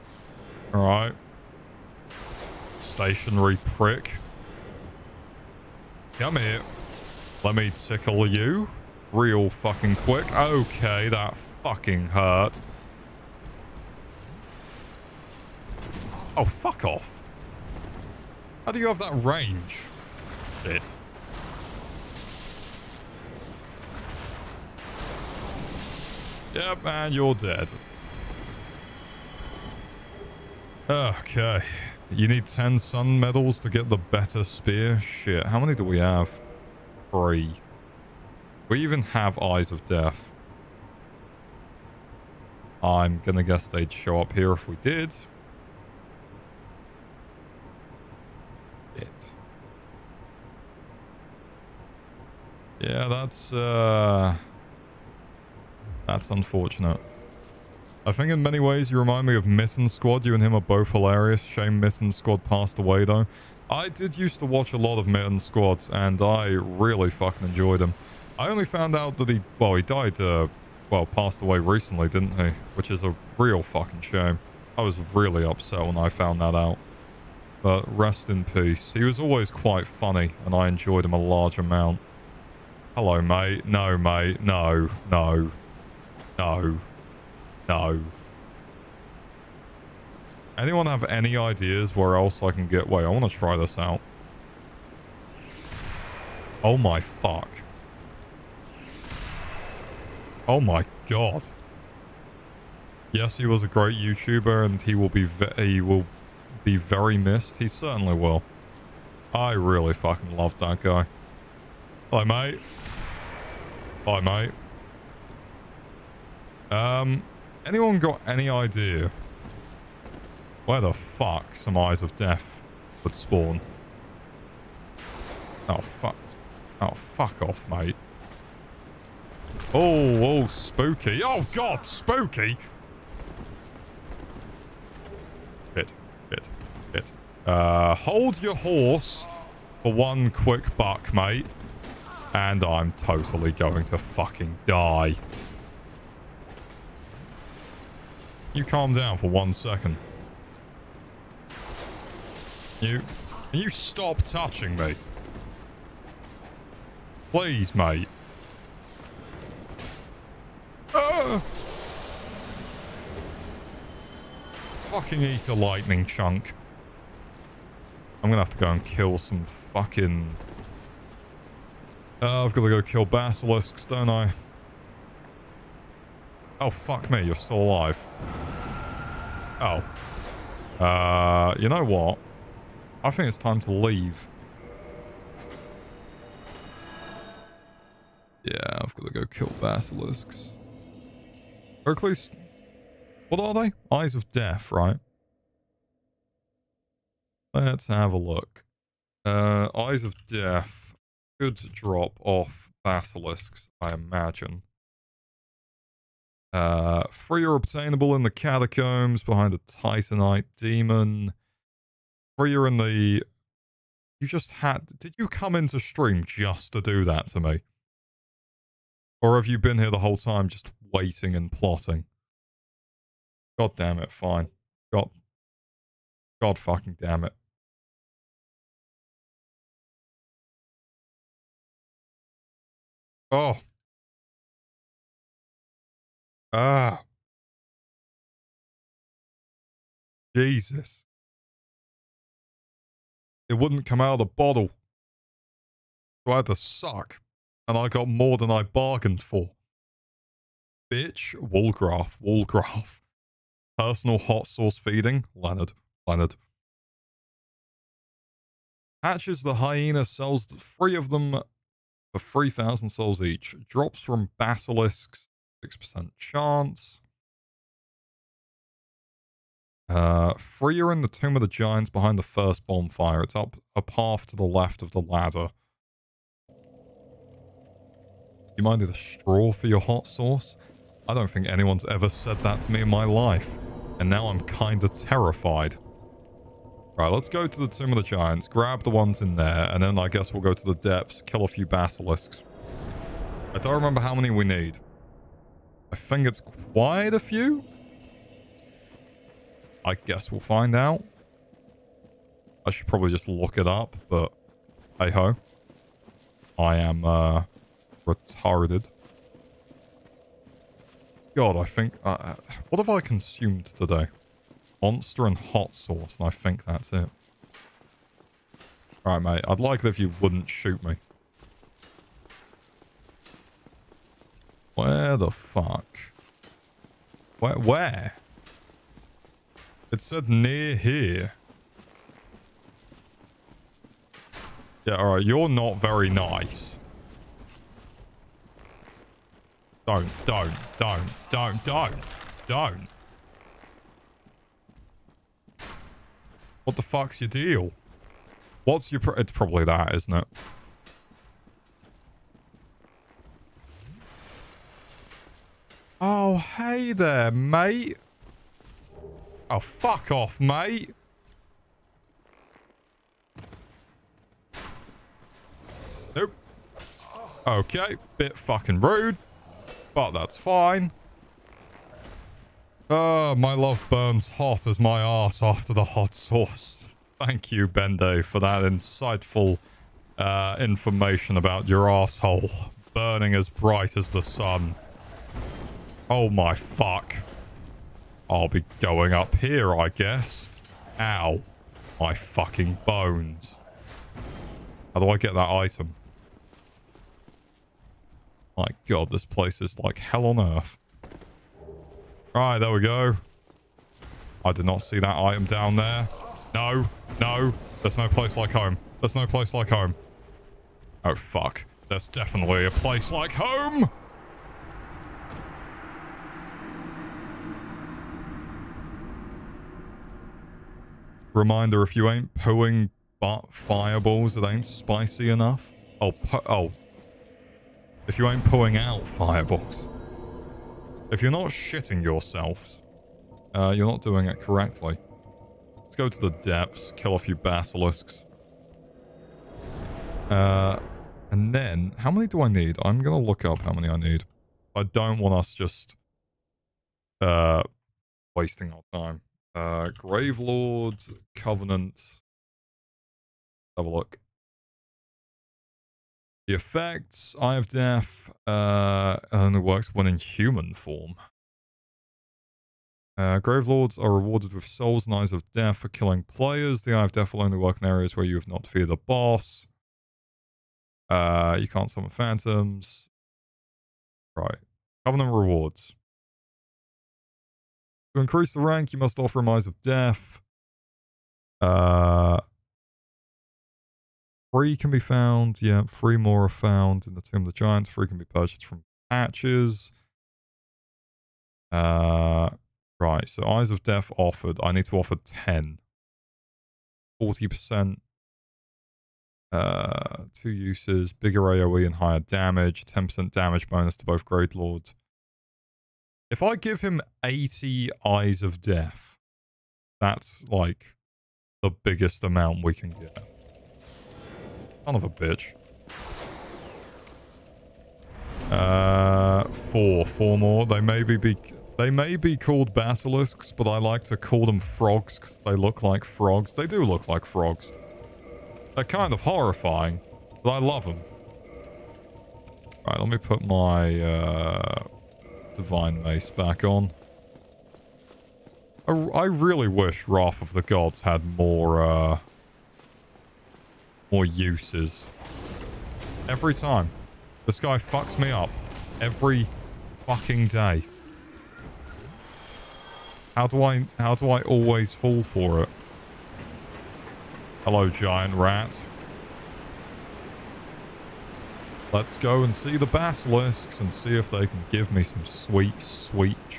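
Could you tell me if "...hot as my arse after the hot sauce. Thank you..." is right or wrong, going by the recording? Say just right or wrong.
right.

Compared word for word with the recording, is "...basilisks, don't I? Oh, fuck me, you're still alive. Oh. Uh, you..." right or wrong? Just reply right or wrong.
right.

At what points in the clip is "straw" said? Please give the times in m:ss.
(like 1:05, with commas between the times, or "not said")
4:38.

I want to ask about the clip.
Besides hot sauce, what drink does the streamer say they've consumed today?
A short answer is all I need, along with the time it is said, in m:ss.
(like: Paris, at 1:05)
Monster, at 5:14.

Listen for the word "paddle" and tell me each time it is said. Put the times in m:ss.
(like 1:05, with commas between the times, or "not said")
not said.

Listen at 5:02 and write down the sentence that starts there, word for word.
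I should probably just look it up, but hey ho.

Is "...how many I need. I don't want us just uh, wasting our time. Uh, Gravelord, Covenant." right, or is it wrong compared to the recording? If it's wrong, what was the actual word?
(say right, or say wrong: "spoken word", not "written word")
right.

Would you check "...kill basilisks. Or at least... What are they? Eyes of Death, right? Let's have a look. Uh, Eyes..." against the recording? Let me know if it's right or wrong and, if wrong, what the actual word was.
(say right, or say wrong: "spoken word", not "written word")
right.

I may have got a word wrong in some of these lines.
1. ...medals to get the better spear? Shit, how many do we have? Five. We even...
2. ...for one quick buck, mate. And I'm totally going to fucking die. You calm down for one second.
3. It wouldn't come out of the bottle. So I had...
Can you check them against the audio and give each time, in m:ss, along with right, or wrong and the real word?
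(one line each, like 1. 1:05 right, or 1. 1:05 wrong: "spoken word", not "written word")
1. 0:33 wrong: "Three", not "Five"
2. 2:19 right
3. 4:03 right.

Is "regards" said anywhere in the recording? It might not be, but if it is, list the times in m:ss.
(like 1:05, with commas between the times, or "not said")
not said.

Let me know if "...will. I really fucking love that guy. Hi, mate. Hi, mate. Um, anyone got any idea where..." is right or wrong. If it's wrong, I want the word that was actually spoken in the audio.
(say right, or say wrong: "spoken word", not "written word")
right.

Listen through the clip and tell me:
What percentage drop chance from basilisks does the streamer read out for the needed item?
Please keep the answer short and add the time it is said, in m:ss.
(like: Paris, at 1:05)
6%, at 4:25.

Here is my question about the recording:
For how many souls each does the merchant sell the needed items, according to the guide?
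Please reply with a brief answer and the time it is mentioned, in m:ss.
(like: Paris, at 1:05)
3,000, at 4:22.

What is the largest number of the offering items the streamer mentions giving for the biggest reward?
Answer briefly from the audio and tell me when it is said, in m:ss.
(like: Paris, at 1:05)
80, at 8:27.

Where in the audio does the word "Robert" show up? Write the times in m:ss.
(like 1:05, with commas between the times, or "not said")
not said.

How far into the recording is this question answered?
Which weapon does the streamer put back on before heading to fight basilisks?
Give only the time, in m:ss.
8:55.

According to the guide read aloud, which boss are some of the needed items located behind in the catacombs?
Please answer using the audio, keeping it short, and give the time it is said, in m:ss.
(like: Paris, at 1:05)
Titanite demon, at 3:29.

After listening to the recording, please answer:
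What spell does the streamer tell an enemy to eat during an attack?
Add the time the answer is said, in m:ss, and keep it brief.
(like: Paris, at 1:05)
lightning chunk, at 2:45.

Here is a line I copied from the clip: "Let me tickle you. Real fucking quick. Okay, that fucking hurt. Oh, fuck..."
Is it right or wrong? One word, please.
right.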